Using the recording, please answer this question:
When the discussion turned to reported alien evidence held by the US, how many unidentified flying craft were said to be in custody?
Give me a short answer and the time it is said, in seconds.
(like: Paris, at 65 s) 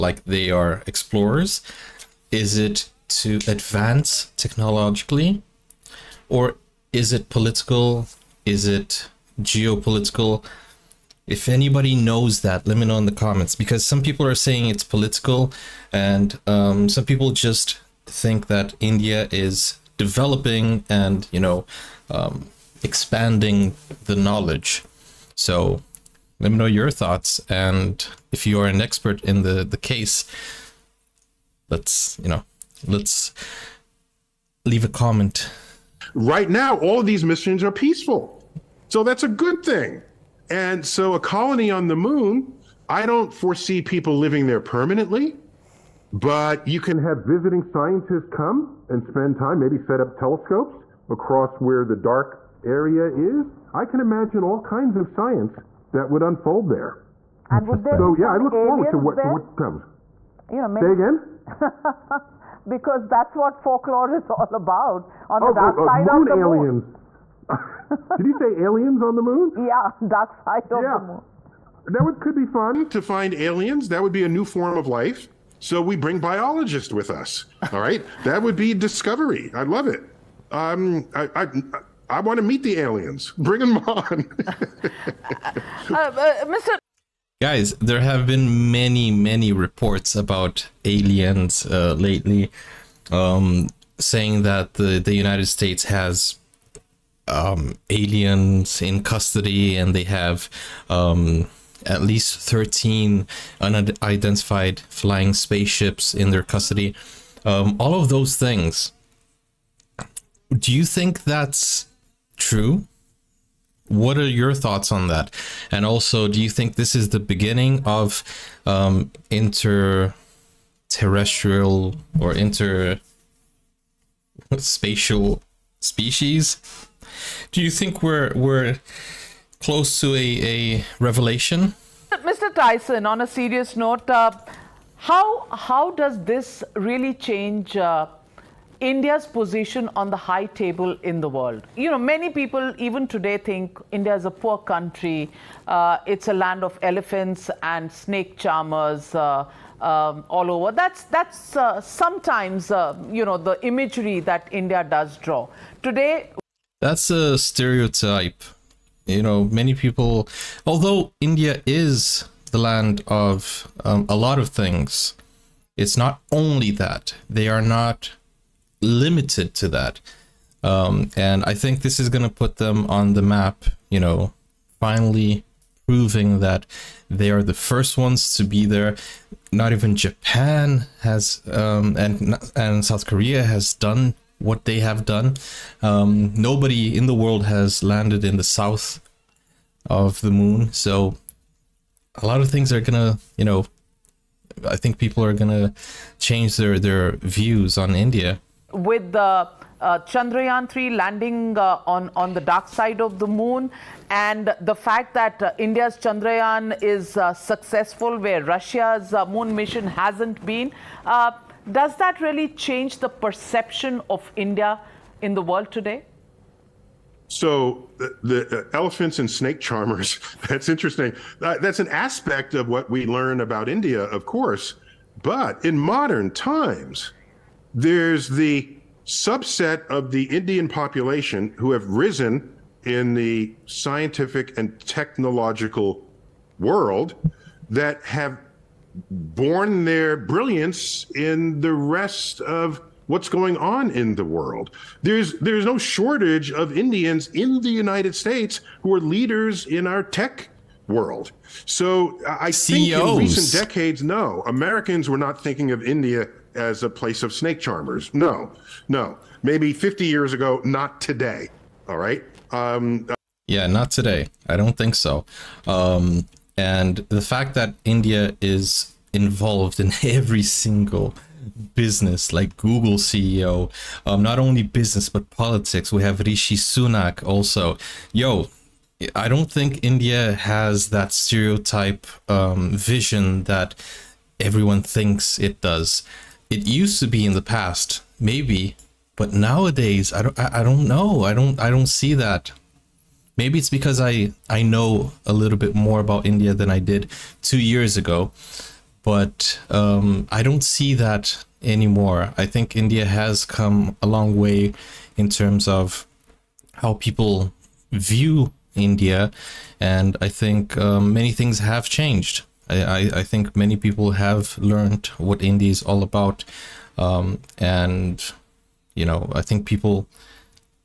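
13, at 102 s.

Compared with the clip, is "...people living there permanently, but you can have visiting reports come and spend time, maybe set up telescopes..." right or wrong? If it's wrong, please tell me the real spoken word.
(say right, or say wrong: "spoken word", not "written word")
wrong: "scientists", not "reports".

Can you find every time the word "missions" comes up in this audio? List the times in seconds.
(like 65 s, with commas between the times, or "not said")
37 s, 209 s.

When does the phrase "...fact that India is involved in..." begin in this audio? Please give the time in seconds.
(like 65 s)
267 s.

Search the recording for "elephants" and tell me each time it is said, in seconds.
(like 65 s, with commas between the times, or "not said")
146 s, 218 s.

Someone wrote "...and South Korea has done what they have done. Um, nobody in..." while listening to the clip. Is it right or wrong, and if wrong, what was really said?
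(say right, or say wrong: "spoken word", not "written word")
right.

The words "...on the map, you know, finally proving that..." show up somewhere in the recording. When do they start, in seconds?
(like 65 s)
172 s.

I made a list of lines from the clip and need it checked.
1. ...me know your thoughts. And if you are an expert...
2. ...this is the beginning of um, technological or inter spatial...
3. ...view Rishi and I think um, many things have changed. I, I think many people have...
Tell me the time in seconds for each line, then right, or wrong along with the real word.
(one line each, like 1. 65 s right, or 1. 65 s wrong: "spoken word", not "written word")
1. 26 s right
2. 116 s wrong: "interterrestrial", not "technological"
3. 307 s wrong: "India", not "Rishi".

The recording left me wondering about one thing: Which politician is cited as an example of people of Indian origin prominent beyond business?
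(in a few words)
Rishi Sunak.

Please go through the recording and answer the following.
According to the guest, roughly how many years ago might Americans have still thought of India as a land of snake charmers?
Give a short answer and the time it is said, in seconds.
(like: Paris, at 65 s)
50 years, at 259 s.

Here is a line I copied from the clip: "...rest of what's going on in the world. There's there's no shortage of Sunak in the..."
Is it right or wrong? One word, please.
wrong.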